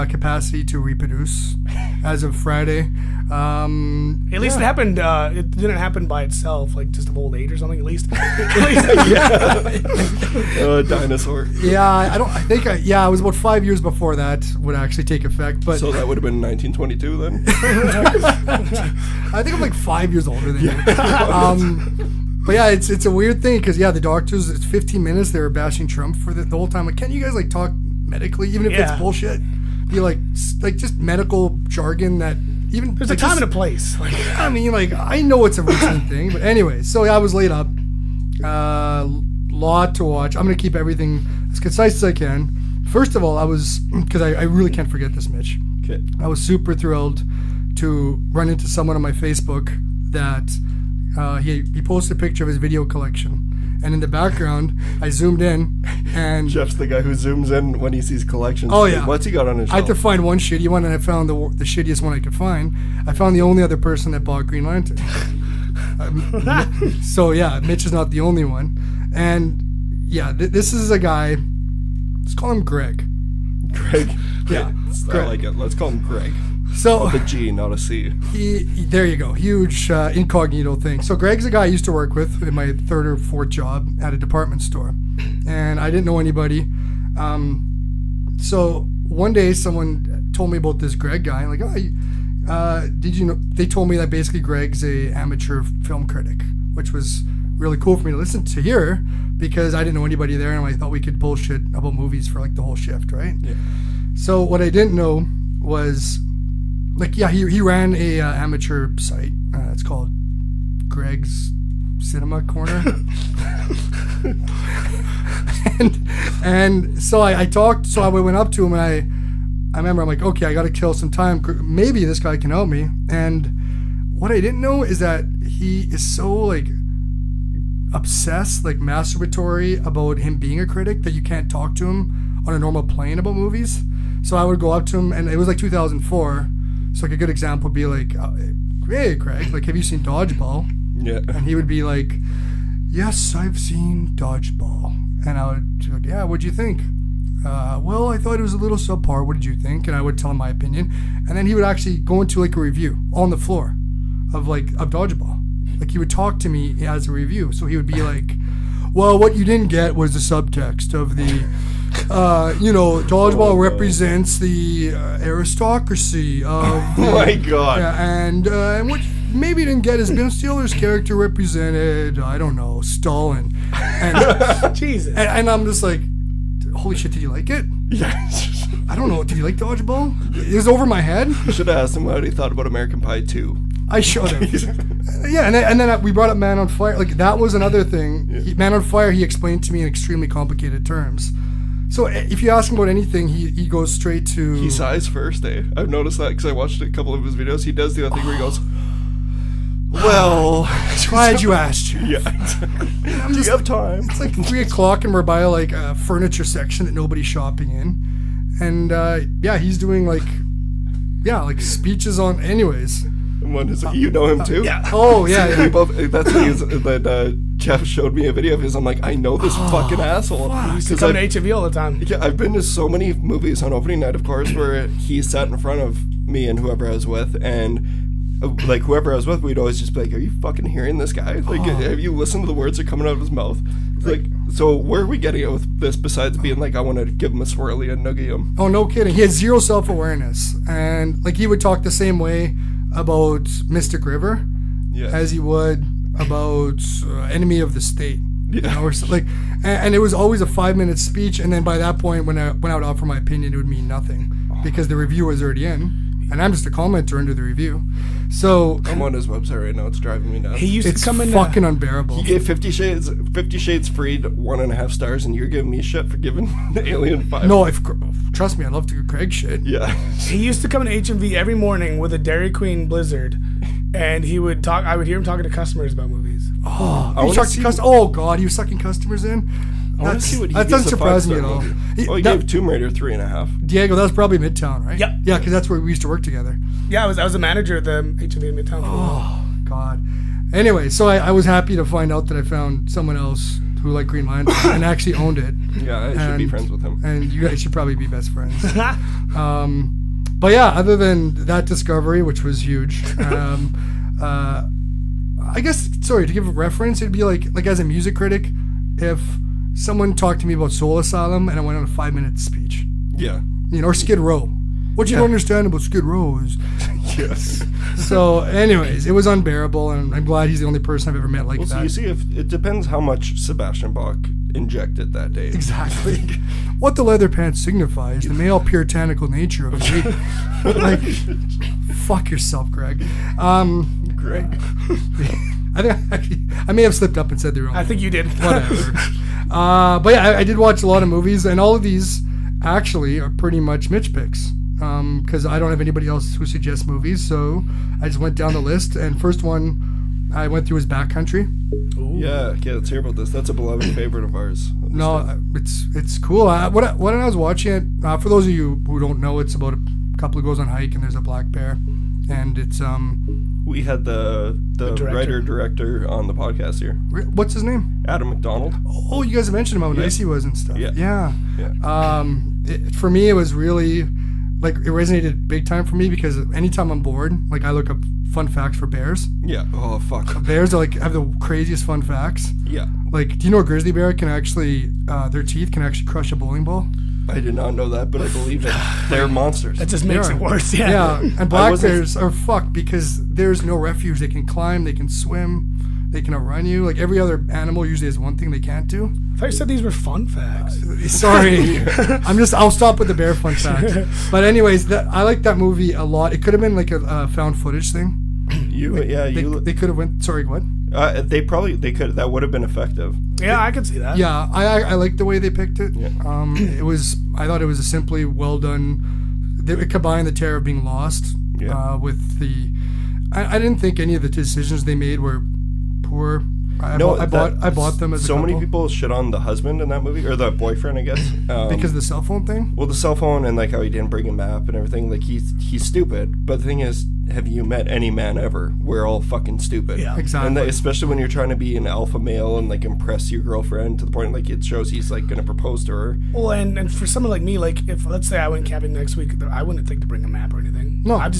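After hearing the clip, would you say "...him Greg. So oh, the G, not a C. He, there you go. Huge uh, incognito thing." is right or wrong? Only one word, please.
right.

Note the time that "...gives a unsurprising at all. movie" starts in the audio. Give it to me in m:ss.
4:40.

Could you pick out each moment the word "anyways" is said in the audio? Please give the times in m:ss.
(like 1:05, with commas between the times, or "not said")
0:36, 3:32, 4:50, 5:18, 6:44.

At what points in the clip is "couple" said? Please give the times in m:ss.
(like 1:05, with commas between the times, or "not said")
3:16, 6:00.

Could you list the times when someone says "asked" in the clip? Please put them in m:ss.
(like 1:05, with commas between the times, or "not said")
3:01, 3:21.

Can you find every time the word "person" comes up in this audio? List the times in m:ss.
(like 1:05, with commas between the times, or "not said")
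1:03, 5:20.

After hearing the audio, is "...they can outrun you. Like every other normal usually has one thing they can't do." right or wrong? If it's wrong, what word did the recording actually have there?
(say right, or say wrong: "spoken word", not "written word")
wrong: "animal", not "normal".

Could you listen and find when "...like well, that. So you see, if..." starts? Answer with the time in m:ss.
5:21.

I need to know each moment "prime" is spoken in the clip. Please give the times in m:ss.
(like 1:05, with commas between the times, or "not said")
not said.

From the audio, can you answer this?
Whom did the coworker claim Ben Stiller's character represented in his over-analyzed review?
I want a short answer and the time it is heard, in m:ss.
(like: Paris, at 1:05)
Stalin, at 2:52.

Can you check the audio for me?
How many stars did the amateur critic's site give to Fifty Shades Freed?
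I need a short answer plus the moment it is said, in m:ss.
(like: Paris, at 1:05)
1.5, at 4:24.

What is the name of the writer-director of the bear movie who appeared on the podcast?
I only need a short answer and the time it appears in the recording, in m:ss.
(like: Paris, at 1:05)
Adam MacDonald, at 6:08.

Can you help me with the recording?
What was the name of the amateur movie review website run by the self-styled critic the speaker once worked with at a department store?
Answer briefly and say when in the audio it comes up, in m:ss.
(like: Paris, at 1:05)
Greg's Cinema Corner, at 1:50.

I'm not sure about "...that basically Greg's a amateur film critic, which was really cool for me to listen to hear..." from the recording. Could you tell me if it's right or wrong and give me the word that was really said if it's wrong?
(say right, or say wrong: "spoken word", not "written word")
right.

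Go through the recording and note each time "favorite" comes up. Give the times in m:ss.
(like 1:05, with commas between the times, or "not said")
5:53.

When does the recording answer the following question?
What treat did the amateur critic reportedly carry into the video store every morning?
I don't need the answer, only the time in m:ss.
4:32.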